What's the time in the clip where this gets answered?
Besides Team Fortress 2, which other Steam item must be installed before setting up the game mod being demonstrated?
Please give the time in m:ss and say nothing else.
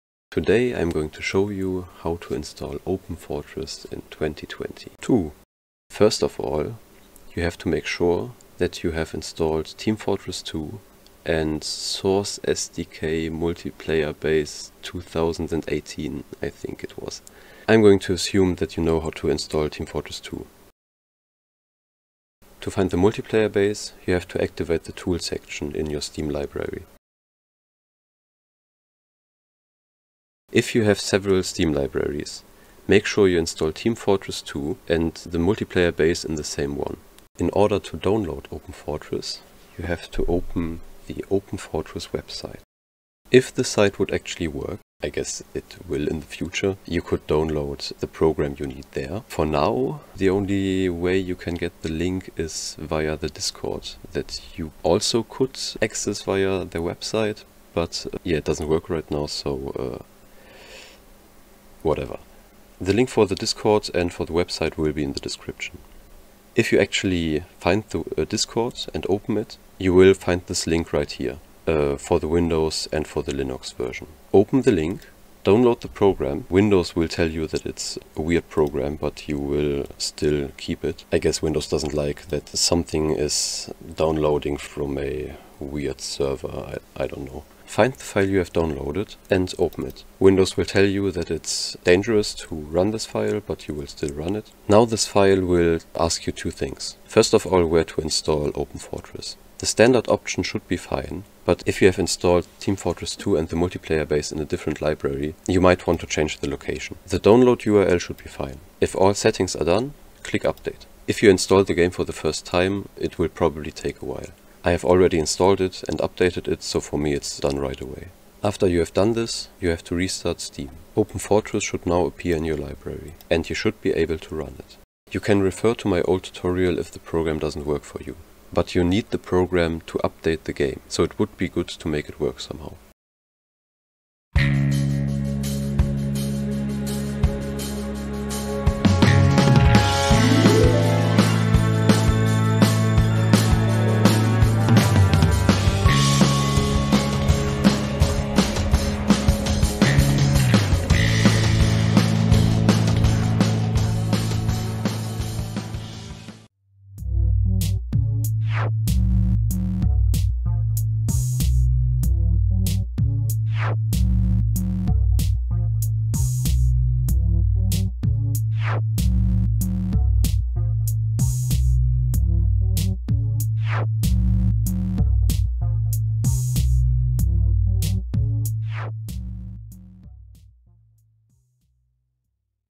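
0:11.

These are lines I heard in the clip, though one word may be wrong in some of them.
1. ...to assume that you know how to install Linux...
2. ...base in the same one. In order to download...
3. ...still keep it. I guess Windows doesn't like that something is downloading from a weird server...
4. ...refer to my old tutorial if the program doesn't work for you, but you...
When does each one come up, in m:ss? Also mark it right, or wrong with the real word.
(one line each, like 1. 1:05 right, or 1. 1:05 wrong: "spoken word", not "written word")
1. 0:17 wrong: "Team", not "Linux"
2. 0:35 right
3. 1:19 right
4. 2:05 right.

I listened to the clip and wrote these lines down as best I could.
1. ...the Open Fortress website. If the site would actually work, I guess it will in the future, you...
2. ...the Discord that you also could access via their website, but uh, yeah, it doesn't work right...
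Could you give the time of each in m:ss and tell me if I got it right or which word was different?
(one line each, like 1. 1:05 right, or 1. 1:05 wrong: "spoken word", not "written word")
1. 0:41 right
2. 0:53 right.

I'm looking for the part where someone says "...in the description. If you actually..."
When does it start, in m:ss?
1:05.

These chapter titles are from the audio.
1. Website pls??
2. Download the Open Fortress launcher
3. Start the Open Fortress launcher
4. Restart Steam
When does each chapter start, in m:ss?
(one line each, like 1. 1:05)
1. 0:36
2. 1:13
3. 1:27
4. 1:58.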